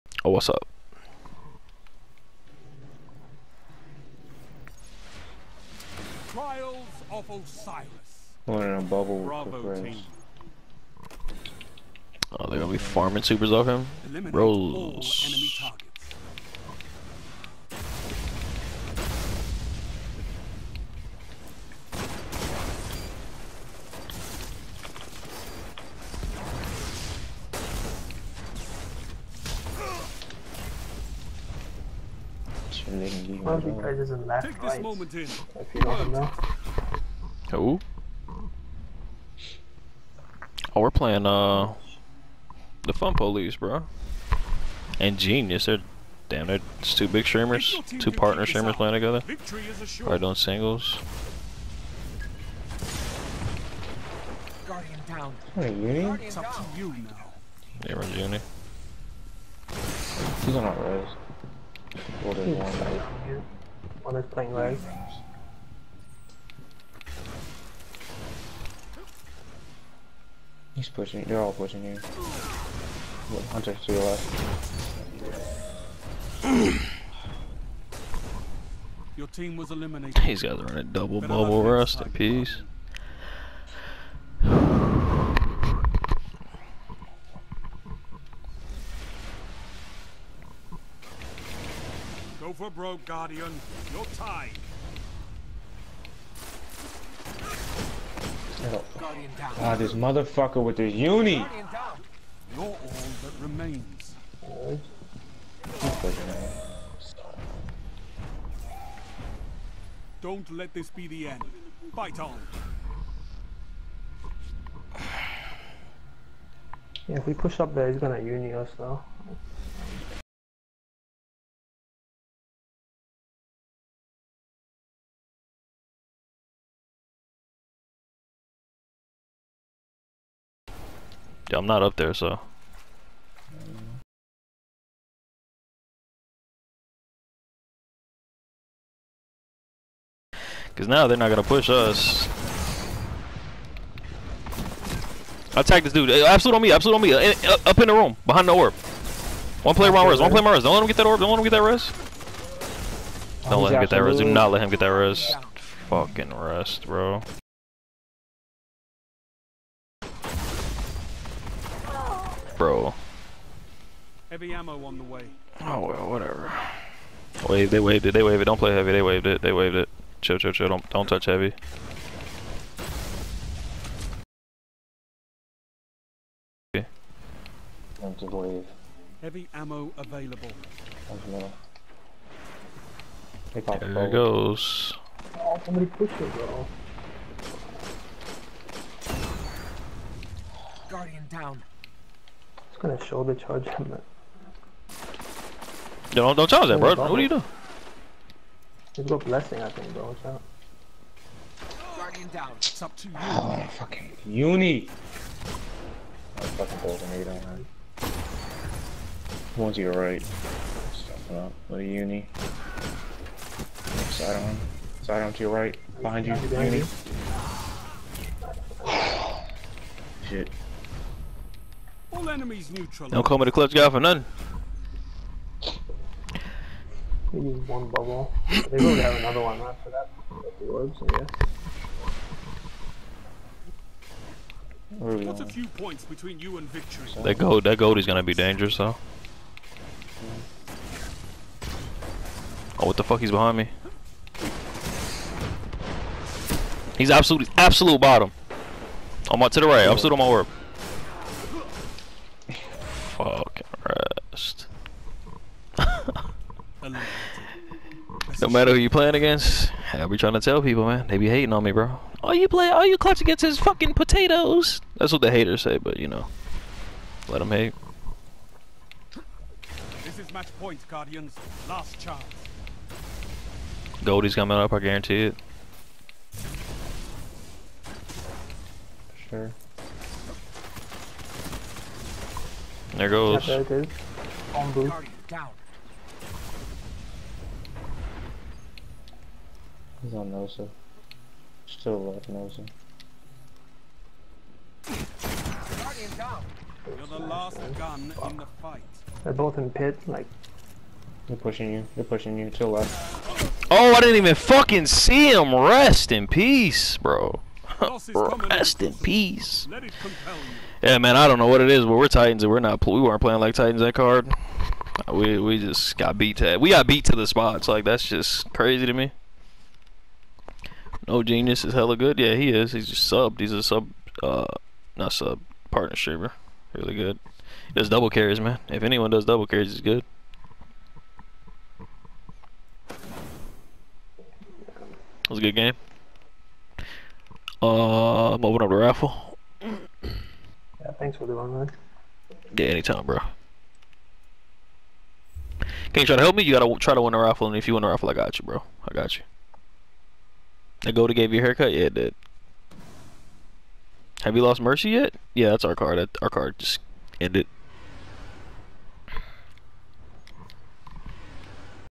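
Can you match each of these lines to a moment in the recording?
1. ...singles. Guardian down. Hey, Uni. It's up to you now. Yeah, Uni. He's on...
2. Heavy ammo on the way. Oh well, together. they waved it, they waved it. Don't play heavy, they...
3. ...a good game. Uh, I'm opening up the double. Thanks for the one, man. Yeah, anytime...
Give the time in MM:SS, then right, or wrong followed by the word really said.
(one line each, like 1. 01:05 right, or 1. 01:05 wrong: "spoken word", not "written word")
1. 00:50 right
2. 02:44 wrong: "whatever", not "together"
3. 05:35 wrong: "raffle", not "double".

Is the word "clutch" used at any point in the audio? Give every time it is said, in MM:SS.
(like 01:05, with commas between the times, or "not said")
03:43, 04:22.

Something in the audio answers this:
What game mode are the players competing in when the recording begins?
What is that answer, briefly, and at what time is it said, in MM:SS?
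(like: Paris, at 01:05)
Trials of Osiris, at 00:06.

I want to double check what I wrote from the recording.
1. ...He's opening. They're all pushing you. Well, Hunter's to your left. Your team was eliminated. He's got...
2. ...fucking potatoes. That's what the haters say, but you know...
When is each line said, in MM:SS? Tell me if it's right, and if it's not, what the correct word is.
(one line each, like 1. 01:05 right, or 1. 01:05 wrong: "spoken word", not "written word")
1. 01:10 wrong: "pushing", not "opening"
2. 04:23 right.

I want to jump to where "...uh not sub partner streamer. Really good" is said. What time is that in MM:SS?
05:24.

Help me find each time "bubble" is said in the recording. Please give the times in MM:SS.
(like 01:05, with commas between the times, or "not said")
00:08, 01:21, 03:47.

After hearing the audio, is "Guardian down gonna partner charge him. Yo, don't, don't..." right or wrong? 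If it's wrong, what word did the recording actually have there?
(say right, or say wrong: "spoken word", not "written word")
wrong: "shoulder", not "partner".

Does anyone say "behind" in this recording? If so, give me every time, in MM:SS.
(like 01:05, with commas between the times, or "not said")
02:28, 03:36, 04:03.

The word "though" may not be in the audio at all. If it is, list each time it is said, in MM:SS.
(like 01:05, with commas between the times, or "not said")
01:58, 03:58.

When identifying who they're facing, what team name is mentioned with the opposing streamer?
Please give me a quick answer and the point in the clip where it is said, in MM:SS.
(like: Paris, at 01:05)
The Fun Police, at 00:42.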